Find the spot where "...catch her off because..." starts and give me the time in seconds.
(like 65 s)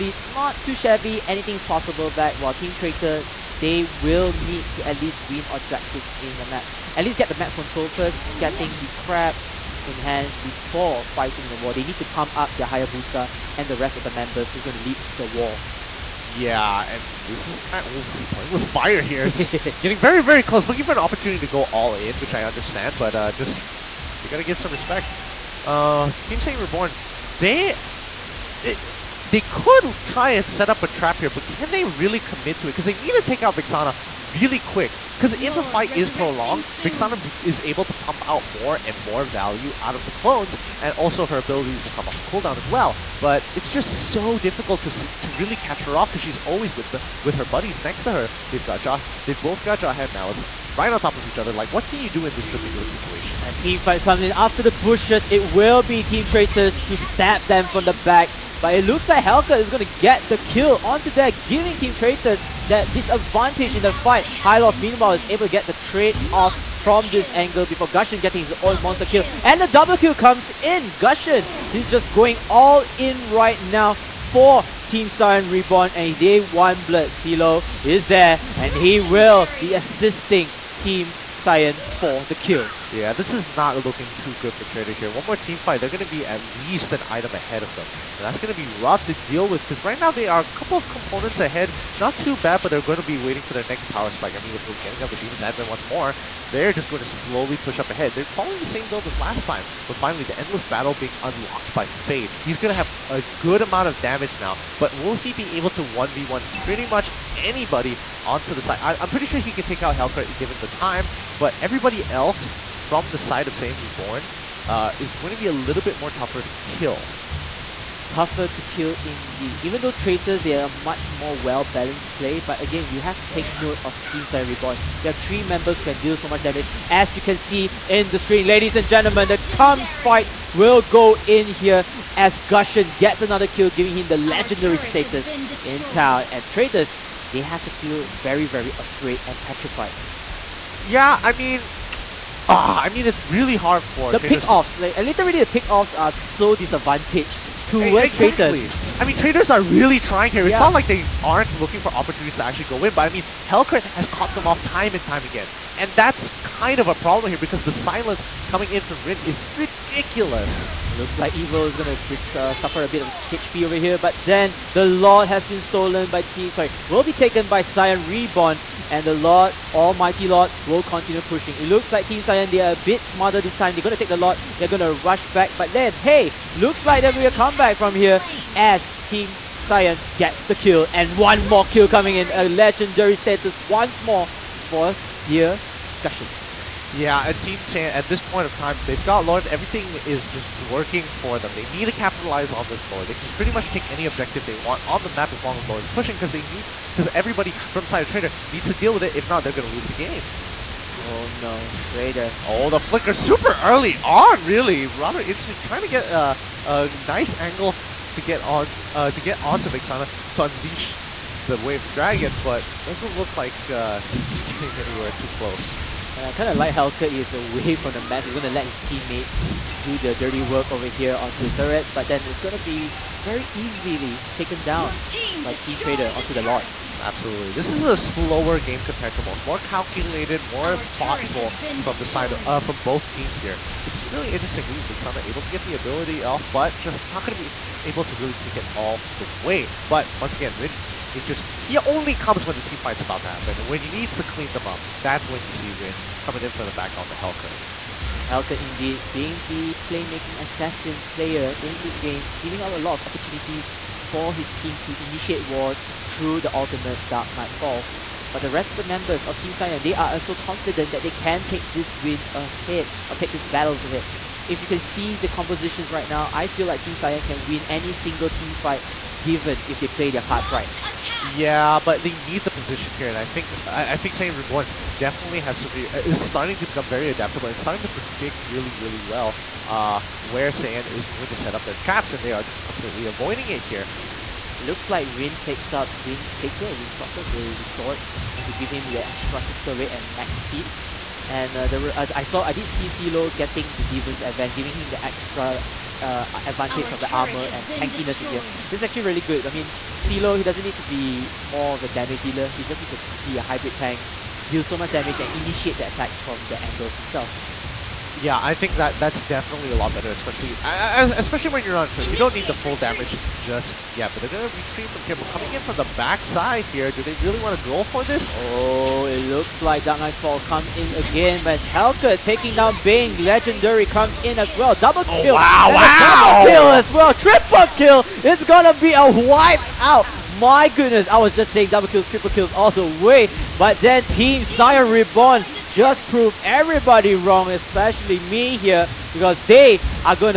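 45 s.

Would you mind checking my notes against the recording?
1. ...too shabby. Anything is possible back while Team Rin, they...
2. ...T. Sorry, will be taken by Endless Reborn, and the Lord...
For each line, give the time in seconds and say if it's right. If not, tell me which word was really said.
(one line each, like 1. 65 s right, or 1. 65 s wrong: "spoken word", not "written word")
1. 0 s wrong: "Traitor", not "Rin"
2. 166 s wrong: "Saiyan", not "Endless".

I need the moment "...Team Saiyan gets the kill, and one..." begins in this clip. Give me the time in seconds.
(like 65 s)
179 s.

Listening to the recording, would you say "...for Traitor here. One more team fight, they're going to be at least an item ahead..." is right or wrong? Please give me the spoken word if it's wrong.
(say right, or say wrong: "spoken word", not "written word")
right.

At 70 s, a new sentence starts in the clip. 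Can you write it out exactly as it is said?
Gusion, he's just going all in right now for Team Saiyan Reborn.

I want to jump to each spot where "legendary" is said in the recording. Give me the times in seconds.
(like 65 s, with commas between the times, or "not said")
134 s, 182 s, 323 s.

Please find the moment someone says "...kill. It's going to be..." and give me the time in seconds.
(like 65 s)
327 s.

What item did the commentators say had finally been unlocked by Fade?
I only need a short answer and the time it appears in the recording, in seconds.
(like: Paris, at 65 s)
Endless Battle, at 100 s.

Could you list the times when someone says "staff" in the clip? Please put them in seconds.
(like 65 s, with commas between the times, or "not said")
not said.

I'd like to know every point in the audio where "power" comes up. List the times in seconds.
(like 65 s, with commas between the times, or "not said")
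93 s.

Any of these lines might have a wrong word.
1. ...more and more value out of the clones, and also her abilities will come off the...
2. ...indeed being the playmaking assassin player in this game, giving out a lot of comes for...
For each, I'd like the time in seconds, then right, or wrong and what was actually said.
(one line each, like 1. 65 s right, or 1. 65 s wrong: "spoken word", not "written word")
1. 38 s right
2. 248 s wrong: "opportunities", not "comes".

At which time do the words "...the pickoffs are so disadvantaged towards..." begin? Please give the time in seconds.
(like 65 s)
145 s.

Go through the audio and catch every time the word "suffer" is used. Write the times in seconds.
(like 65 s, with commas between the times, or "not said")
162 s.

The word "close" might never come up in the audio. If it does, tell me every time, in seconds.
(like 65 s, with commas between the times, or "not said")
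20 s, 215 s.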